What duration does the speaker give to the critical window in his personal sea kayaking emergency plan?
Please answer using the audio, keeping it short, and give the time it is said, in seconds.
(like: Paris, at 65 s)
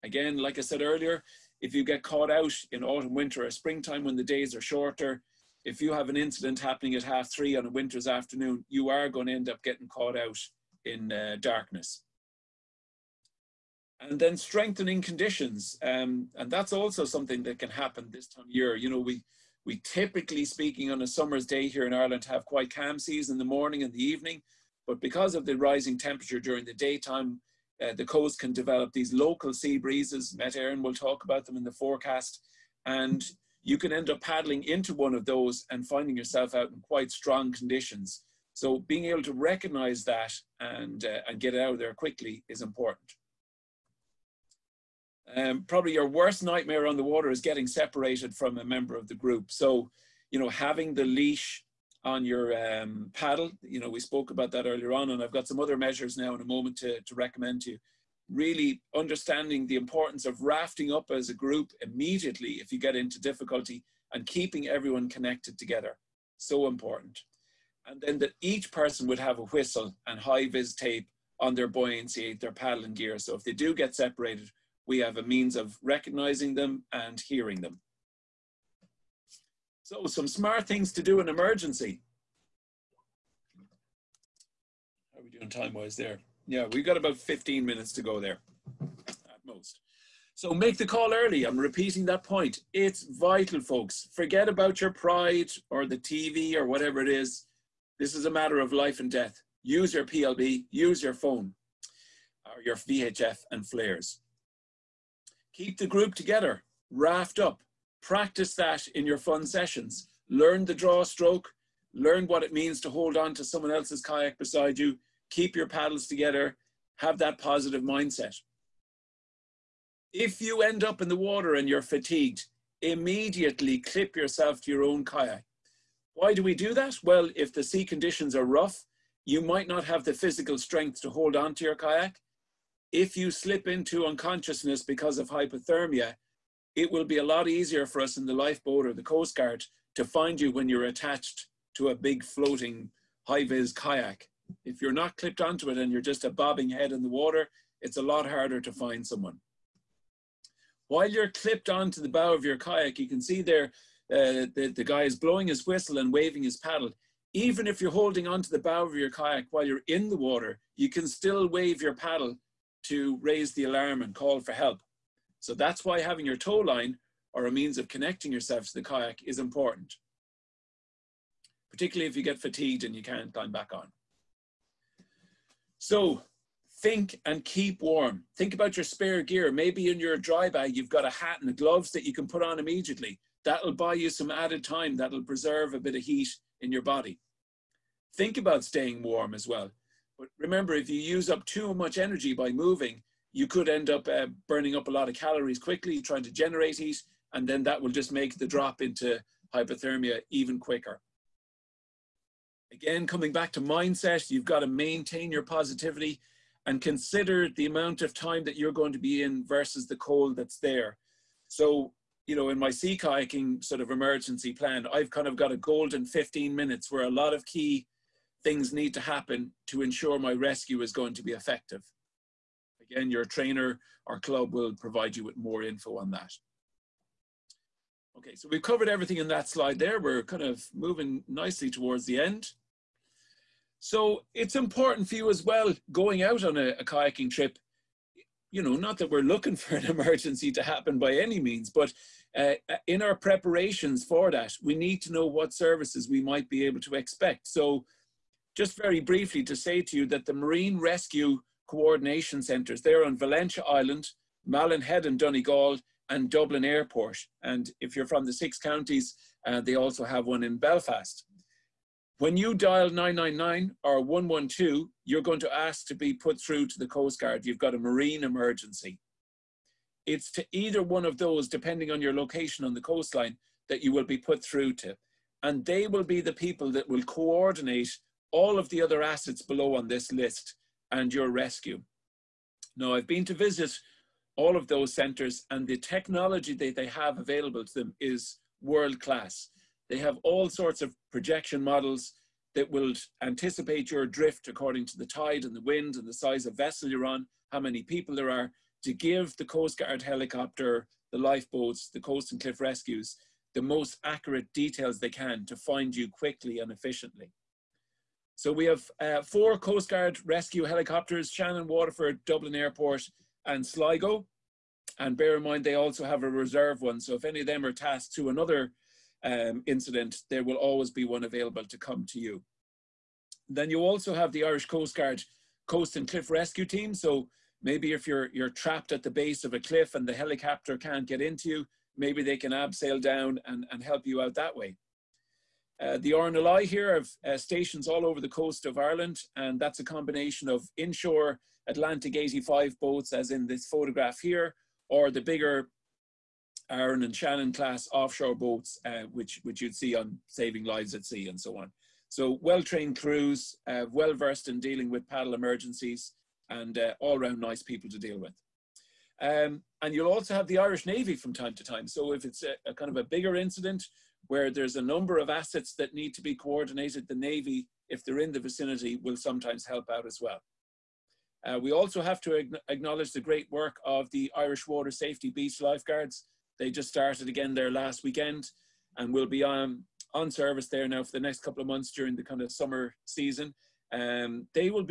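15 minutes, at 215 s.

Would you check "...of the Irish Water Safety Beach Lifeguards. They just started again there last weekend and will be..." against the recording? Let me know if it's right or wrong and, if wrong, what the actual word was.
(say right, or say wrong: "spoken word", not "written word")
right.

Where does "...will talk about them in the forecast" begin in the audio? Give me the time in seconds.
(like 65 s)
30 s.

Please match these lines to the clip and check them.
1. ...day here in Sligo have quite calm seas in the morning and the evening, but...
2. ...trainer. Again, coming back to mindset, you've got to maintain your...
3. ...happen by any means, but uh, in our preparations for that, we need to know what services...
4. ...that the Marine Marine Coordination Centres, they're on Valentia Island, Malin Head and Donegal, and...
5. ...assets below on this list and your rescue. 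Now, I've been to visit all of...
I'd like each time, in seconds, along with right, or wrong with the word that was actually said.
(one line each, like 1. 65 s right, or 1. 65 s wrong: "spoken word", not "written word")
1. 21 s wrong: "Ireland", not "Sligo"
2. 200 s wrong: "quicker", not "trainer"
3. 240 s right
4. 250 s wrong: "Rescue", not "Marine"
5. 279 s right.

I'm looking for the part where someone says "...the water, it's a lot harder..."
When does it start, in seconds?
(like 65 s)
147 s.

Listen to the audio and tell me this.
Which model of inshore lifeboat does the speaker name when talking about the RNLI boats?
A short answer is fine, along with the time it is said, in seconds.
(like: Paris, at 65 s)
Atlantic 85, at 341 s.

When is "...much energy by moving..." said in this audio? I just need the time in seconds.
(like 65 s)
191 s.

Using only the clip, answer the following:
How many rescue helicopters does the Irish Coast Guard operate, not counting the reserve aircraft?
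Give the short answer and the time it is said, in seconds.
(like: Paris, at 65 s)
4, at 309 s.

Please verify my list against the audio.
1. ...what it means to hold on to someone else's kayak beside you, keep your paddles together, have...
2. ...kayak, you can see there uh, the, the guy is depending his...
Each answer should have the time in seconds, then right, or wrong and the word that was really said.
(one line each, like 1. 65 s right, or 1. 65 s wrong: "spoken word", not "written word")
1. 112 s right
2. 152 s wrong: "blowing", not "depending".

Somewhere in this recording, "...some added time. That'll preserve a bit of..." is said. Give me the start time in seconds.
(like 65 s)
184 s.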